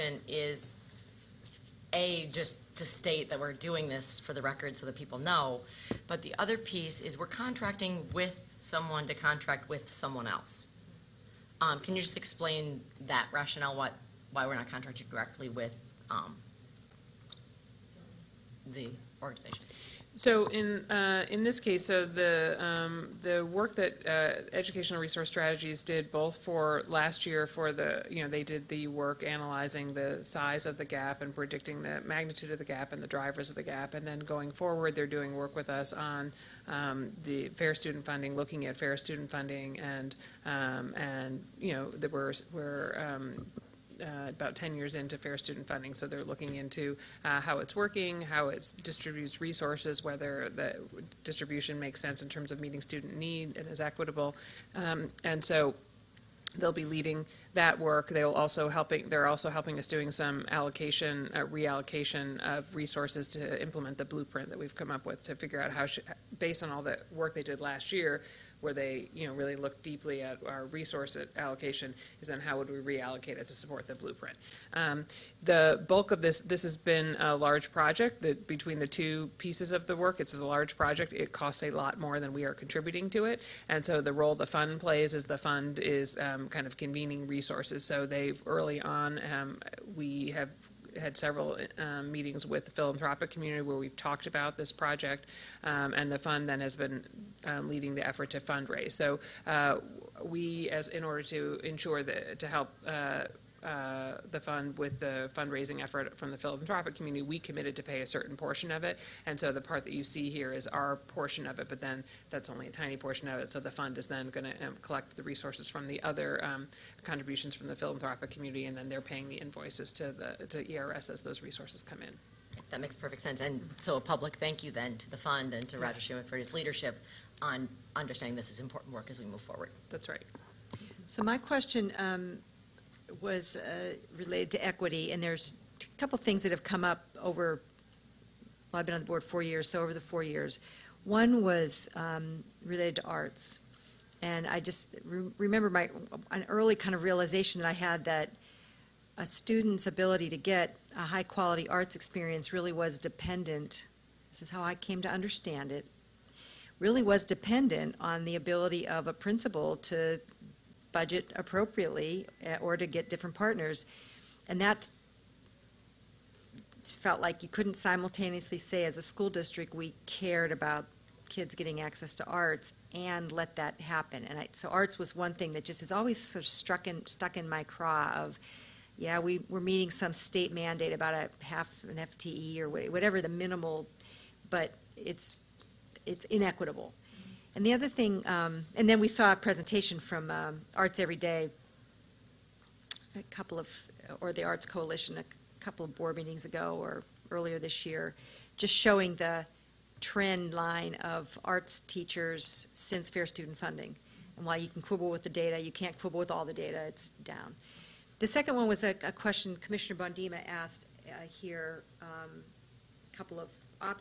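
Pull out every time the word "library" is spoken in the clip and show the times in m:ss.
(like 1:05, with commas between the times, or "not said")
not said.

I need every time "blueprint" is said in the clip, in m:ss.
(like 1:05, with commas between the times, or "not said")
1:04, 1:13.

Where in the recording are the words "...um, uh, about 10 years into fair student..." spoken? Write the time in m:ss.
0:43.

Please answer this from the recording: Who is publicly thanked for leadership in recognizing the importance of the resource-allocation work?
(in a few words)
Roger Schulman.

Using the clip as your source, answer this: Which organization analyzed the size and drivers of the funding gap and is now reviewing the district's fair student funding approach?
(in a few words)
Educational Resource Strategies.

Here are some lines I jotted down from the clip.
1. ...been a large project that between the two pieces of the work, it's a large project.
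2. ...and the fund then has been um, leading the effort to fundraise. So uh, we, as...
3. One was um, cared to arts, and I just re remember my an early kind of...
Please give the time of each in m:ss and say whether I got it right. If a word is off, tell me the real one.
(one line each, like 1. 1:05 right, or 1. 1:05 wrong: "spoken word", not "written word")
1. 1:16 right
2. 1:35 right
3. 2:21 wrong: "related", not "cared".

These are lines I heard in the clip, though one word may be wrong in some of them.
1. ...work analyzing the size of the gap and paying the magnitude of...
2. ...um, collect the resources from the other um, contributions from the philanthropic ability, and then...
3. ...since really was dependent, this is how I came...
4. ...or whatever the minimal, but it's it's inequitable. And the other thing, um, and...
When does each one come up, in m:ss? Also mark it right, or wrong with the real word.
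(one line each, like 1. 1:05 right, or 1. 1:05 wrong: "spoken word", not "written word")
1. 0:28 wrong: "predicting", not "paying"
2. 1:54 wrong: "community", not "ability"
3. 2:31 wrong: "experience", not "since"
4. 3:02 right.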